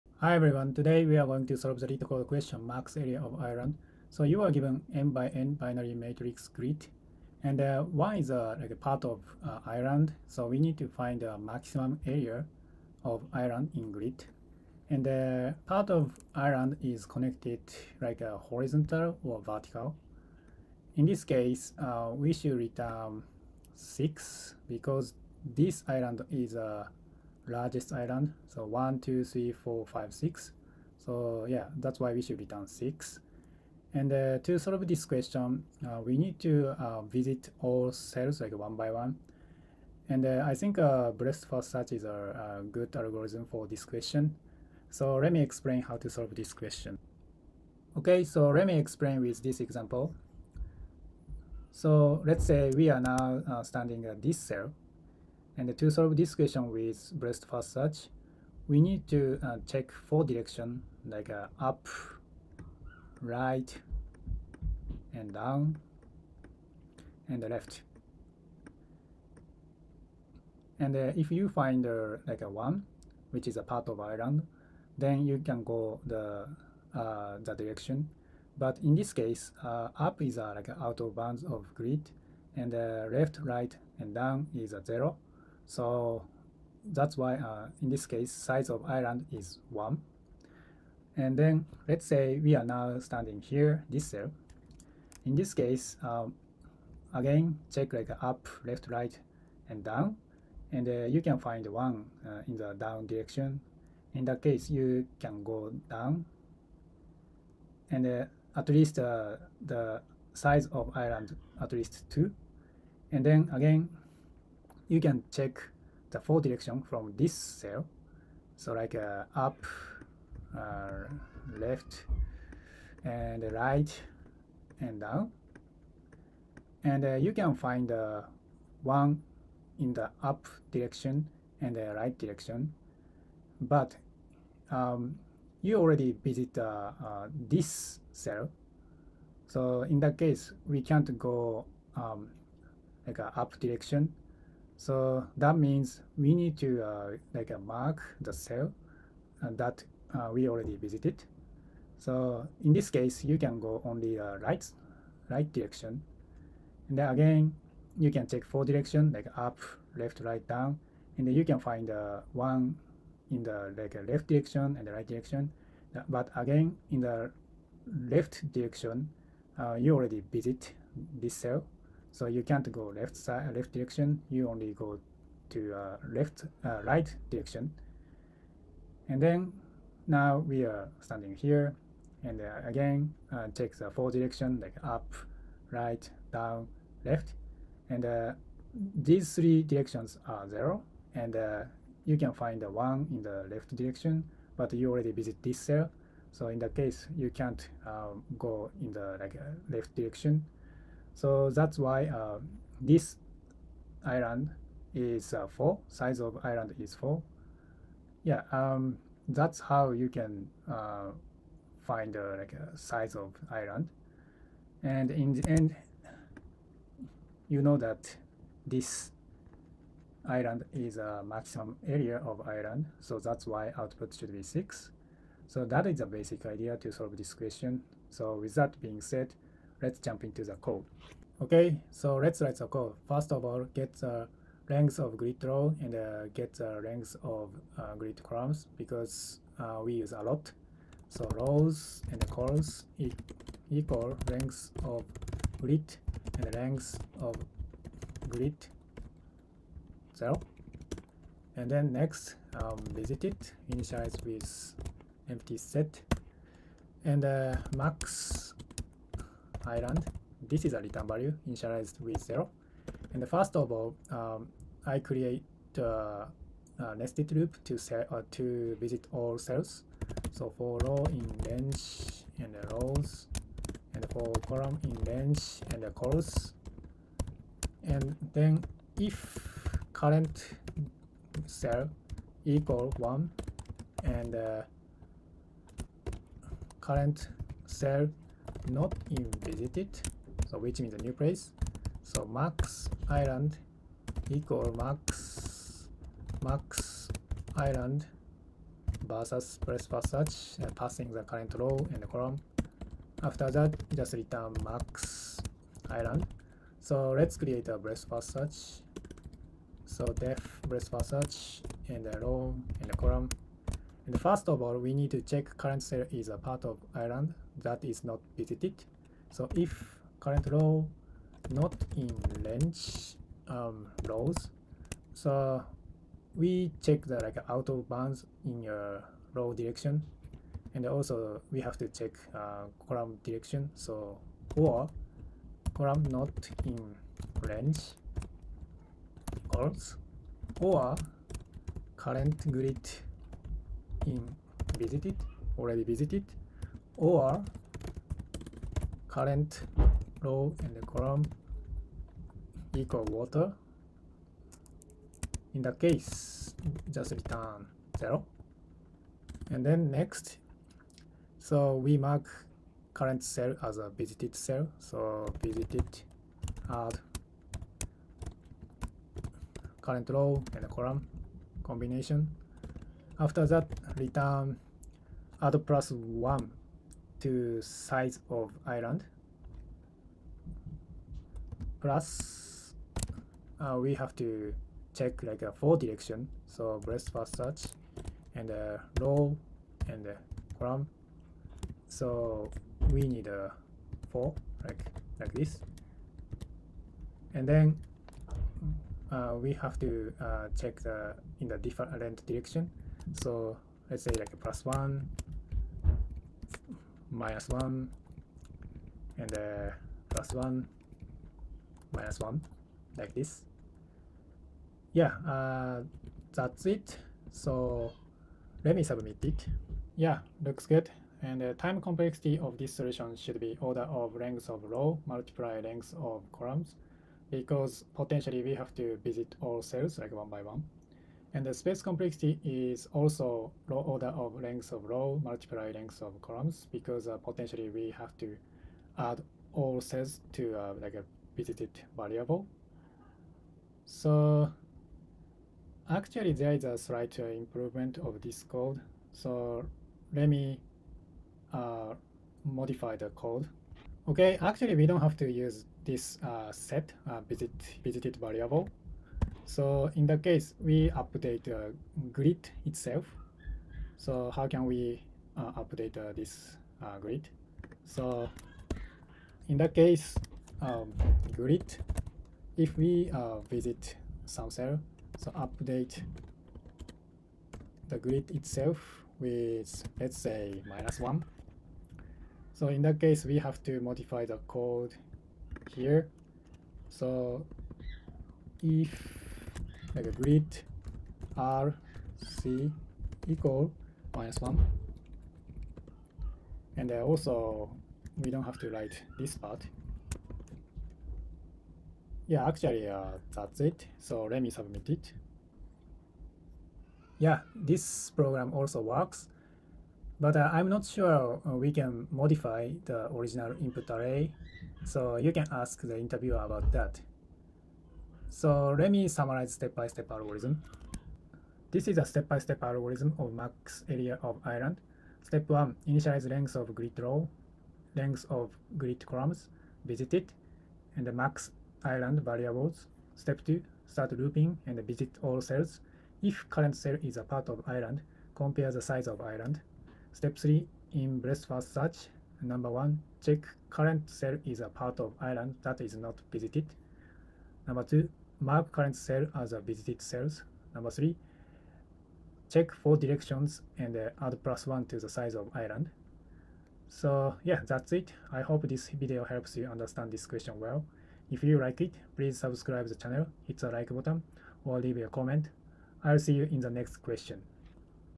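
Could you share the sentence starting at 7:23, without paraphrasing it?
So actually there is a slight uh, improvement of this code.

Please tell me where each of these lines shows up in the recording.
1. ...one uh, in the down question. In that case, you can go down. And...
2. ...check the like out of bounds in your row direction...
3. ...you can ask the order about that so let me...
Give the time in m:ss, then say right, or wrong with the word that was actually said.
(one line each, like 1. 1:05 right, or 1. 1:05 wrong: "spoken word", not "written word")
1. 1:41 wrong: "direction", not "question"
2. 5:26 right
3. 8:35 wrong: "interviewer", not "order".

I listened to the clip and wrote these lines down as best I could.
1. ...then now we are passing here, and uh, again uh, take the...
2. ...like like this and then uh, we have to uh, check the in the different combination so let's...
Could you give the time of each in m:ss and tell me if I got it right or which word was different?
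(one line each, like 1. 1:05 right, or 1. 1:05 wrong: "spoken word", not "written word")
1. 2:59 wrong: "standing", not "passing"
2. 6:34 wrong: "direction", not "combination".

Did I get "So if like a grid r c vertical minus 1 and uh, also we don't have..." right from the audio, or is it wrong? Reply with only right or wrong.
wrong.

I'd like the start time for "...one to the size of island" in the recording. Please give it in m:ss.
9:14.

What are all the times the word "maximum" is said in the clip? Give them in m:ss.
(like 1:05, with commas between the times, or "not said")
0:11, 3:41.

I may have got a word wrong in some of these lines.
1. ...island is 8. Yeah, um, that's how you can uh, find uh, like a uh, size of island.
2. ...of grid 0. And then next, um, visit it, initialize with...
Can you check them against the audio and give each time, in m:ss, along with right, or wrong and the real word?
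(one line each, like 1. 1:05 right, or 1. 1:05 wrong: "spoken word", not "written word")
1. 3:26 wrong: "4", not "8"
2. 4:07 right.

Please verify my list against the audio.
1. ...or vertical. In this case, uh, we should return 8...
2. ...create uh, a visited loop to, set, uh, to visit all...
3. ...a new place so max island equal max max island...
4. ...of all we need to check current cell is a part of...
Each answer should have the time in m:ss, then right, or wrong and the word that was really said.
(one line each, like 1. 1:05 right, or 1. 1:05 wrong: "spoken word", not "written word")
1. 0:19 wrong: "6", not "8"
2. 4:24 wrong: "nested", not "visited"
3. 4:50 right
4. 5:14 right.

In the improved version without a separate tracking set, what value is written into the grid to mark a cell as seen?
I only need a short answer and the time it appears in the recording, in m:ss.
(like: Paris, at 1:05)
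-1, at 8:00.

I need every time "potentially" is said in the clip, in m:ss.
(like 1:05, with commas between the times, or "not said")
7:07, 7:17.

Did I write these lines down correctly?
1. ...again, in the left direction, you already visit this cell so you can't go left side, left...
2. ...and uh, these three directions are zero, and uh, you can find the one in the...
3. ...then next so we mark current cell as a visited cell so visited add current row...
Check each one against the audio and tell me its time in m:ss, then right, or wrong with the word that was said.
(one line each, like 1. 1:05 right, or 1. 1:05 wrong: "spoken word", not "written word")
1. 2:46 right
2. 3:07 right
3. 5:59 right.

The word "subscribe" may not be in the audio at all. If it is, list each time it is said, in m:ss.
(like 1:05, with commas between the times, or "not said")
9:22.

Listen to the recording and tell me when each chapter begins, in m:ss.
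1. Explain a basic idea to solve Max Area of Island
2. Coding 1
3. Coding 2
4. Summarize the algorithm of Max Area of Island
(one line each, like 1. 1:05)
1. 0:47
2. 3:51
3. 7:34
4. 8:41.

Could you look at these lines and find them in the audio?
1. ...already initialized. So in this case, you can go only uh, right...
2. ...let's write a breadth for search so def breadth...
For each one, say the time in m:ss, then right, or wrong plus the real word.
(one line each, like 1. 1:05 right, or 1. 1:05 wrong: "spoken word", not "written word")
1. 2:30 wrong: "visited", not "initialized"
2. 5:07 wrong: "create", not "write".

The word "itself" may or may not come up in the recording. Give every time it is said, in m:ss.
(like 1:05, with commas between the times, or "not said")
7:42, 7:58.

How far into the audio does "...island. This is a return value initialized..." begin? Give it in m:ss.
4:19.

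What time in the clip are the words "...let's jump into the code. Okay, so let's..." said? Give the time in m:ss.
3:49.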